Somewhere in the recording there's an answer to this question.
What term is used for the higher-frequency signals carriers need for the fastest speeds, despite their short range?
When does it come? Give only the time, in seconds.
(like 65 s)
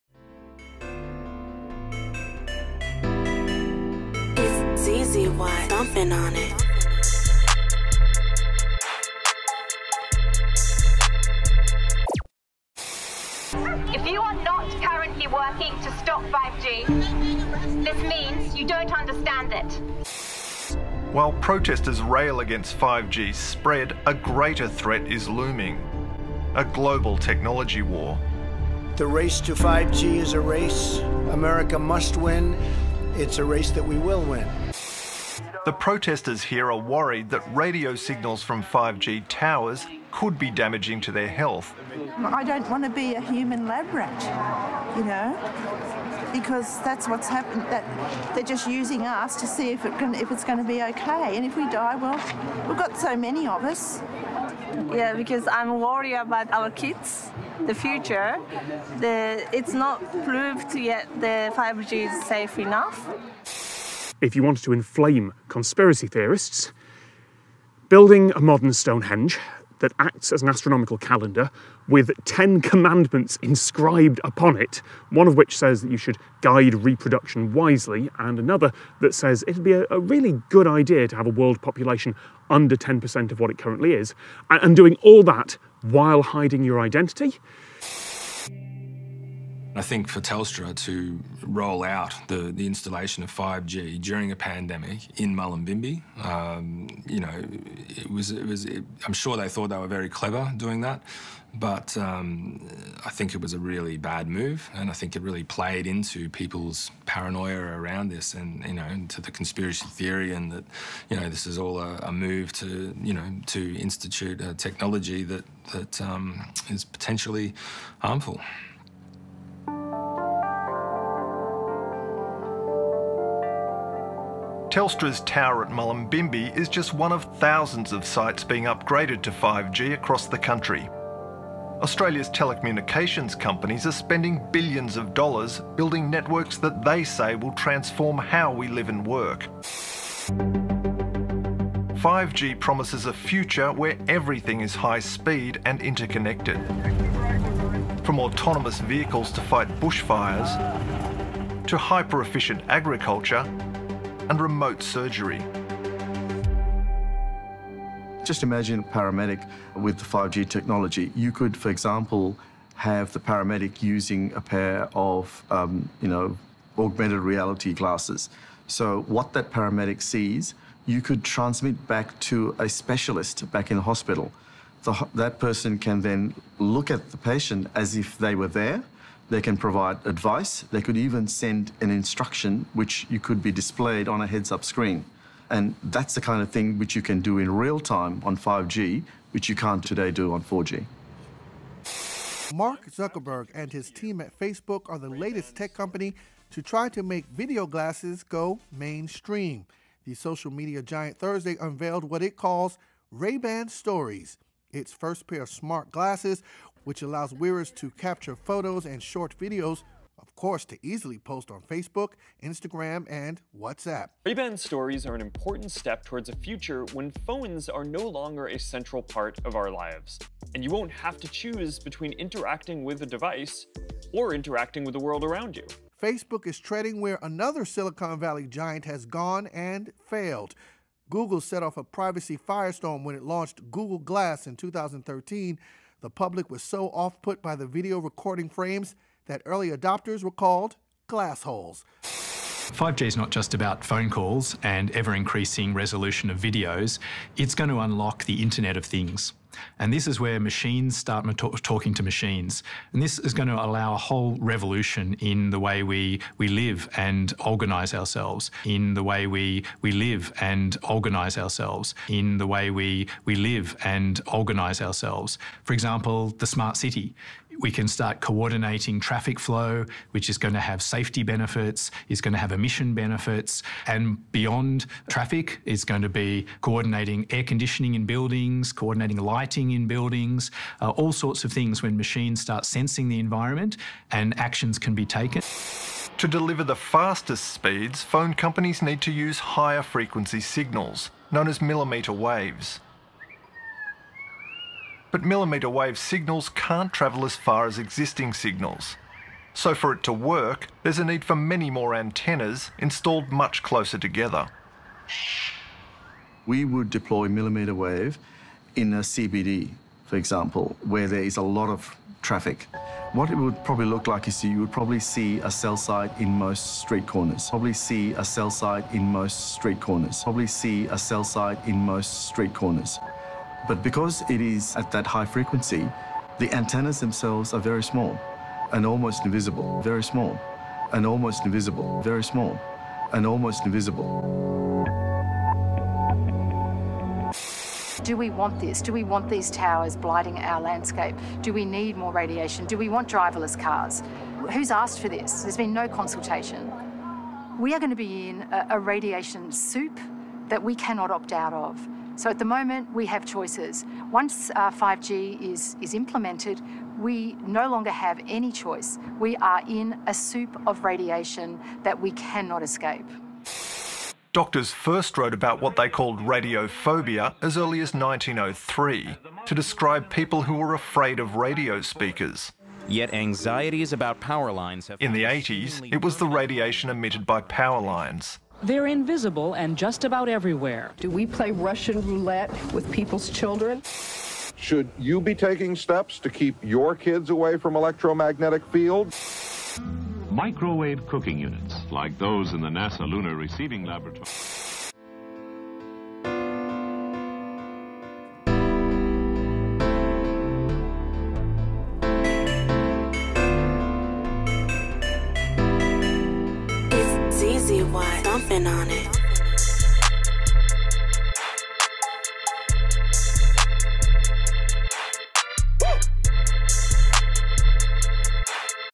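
291 s.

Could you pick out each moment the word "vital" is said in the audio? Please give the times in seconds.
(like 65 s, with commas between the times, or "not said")
not said.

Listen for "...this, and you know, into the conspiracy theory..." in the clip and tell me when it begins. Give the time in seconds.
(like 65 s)
108 s.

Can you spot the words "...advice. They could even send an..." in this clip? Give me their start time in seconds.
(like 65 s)
180 s.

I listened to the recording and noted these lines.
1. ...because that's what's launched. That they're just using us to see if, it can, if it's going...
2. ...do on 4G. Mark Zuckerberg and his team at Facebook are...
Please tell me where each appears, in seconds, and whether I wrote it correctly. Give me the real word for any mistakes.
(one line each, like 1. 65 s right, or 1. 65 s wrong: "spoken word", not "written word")
1. 46 s wrong: "happened", not "launched"
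2. 190 s right.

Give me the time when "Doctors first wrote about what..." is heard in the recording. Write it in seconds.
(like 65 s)
364 s.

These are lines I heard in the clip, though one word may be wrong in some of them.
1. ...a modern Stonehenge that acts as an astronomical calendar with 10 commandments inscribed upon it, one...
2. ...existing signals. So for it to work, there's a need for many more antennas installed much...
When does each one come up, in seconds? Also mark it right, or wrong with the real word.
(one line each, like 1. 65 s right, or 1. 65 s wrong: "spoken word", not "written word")
1. 68 s right
2. 297 s right.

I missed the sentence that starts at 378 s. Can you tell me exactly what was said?
They're invisible and just about everywhere.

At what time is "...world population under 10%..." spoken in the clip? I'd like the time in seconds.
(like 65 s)
81 s.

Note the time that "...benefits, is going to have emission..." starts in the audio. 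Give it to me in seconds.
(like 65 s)
271 s.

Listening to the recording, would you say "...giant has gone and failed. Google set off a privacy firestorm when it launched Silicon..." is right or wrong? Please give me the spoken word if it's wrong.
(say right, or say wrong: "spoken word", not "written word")
wrong: "Google", not "Silicon".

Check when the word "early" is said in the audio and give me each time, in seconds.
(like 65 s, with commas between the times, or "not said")
239 s, 367 s.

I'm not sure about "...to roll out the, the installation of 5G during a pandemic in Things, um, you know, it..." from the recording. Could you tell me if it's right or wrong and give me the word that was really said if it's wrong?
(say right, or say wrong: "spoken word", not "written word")
wrong: "Mullumbimby", not "Things".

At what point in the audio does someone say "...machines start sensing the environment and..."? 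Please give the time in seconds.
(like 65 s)
281 s.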